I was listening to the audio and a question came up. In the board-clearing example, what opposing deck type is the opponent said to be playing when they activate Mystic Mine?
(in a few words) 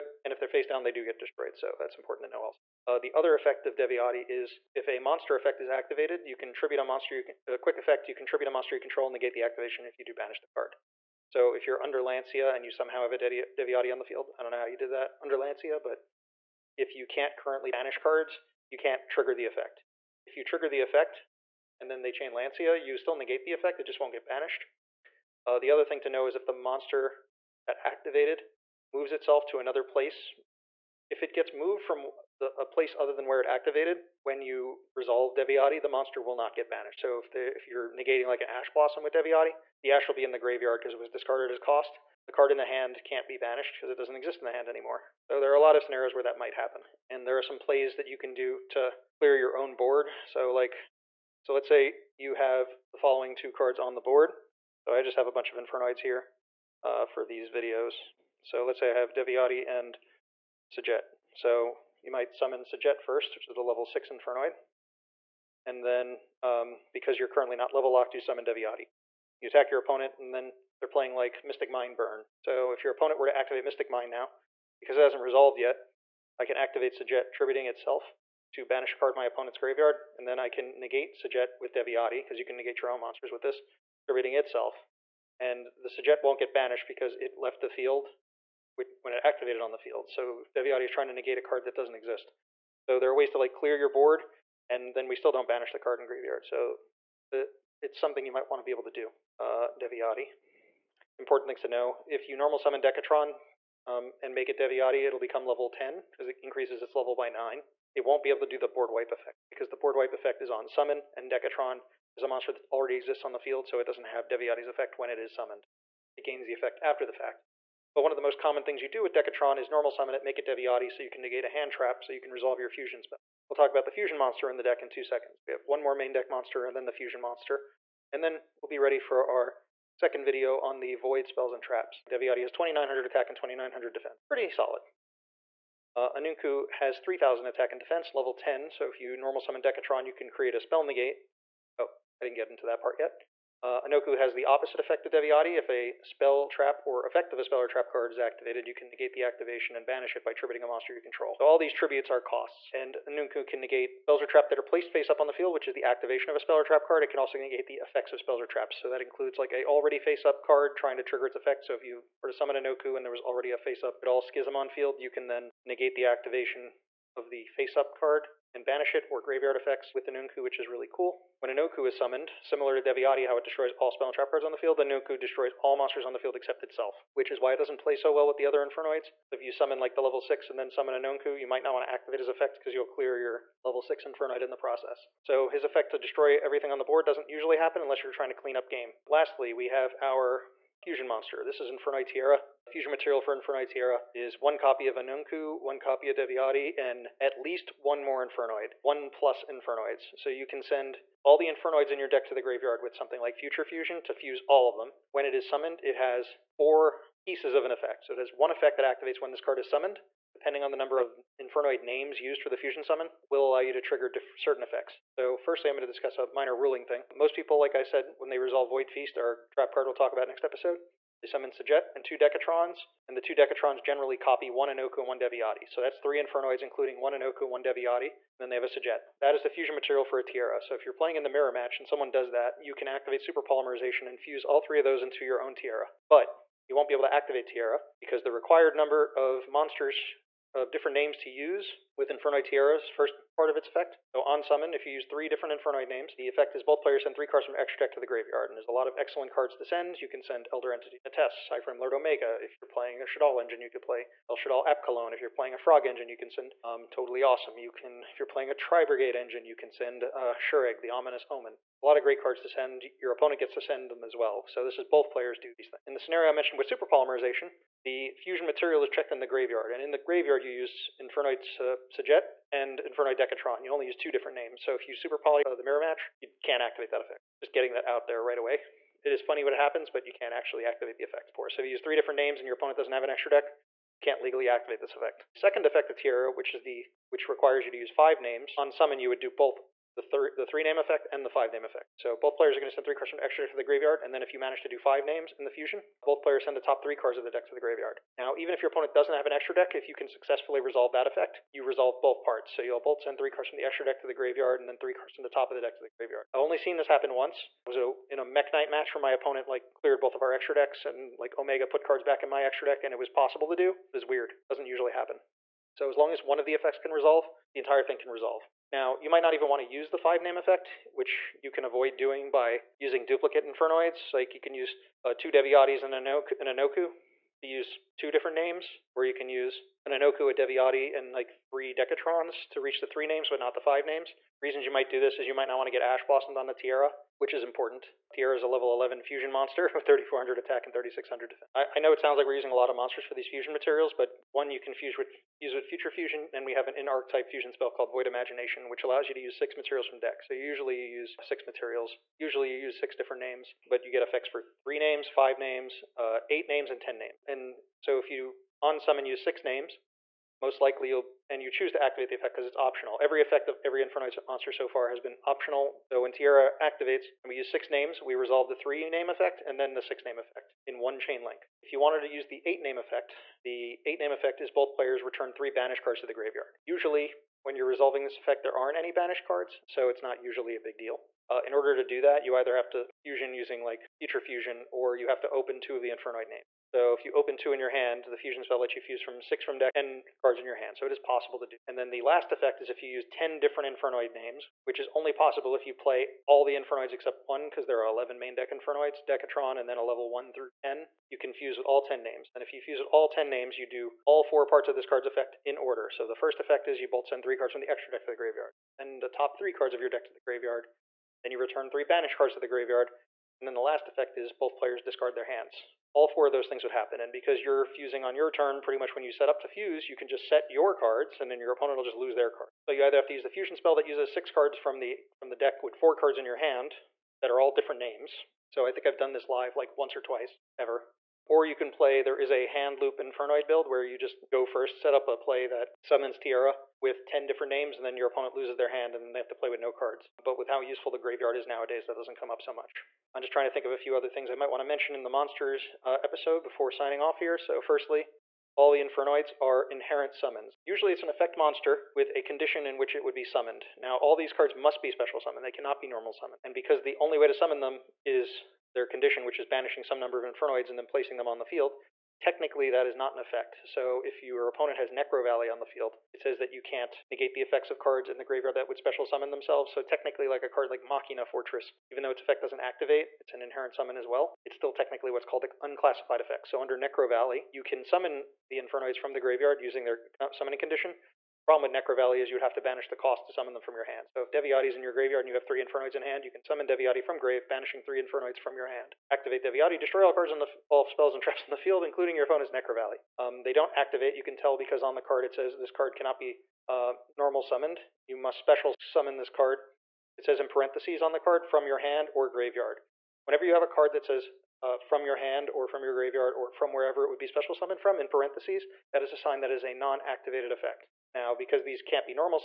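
Mystic Mine Burn.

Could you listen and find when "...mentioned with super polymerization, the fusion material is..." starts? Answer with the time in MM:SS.
04:26.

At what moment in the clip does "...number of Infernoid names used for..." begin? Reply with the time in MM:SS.
03:30.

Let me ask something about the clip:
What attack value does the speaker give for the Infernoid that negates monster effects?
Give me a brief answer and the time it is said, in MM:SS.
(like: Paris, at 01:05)
2900, at 02:12.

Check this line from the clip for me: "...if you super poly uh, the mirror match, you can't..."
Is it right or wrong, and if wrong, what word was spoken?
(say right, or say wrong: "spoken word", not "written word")
right.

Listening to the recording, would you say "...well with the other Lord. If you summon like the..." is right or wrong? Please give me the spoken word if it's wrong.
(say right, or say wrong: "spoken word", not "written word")
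wrong: "Infernoids", not "Lord".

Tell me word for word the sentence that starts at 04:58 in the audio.
Now, even if your opponent doesn't have an extra deck, if you can successfully resolve that effect, you resolve both parts.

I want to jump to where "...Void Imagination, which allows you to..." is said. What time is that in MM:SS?
05:47.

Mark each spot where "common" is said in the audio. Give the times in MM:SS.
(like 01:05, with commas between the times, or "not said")
01:58.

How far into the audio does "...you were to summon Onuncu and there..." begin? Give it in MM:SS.
02:41.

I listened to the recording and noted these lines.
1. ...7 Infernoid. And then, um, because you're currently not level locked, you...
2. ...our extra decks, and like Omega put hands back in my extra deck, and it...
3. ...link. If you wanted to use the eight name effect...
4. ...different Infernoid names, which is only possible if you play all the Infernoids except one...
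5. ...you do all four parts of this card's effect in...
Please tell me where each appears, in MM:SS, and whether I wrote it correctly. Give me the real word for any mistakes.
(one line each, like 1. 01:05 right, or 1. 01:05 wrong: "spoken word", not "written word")
1. 01:03 wrong: "6", not "7"
2. 05:10 wrong: "cards", not "hands"
3. 06:11 right
4. 06:33 right
5. 06:43 right.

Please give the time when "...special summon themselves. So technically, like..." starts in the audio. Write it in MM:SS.
07:48.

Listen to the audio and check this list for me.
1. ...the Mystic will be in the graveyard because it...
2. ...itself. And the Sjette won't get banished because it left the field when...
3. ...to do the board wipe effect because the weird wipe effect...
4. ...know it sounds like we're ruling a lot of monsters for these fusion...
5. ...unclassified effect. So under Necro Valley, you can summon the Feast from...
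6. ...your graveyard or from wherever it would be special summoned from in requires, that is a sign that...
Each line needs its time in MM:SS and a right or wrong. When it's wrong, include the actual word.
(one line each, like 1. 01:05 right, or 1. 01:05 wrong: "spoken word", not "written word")
1. 00:39 wrong: "Ash", not "Mystic"
2. 01:24 right
3. 01:48 wrong: "board", not "weird"
4. 05:41 wrong: "using", not "ruling"
5. 07:55 wrong: "Infernoids", not "Feast"
6. 08:25 wrong: "parentheses", not "requires".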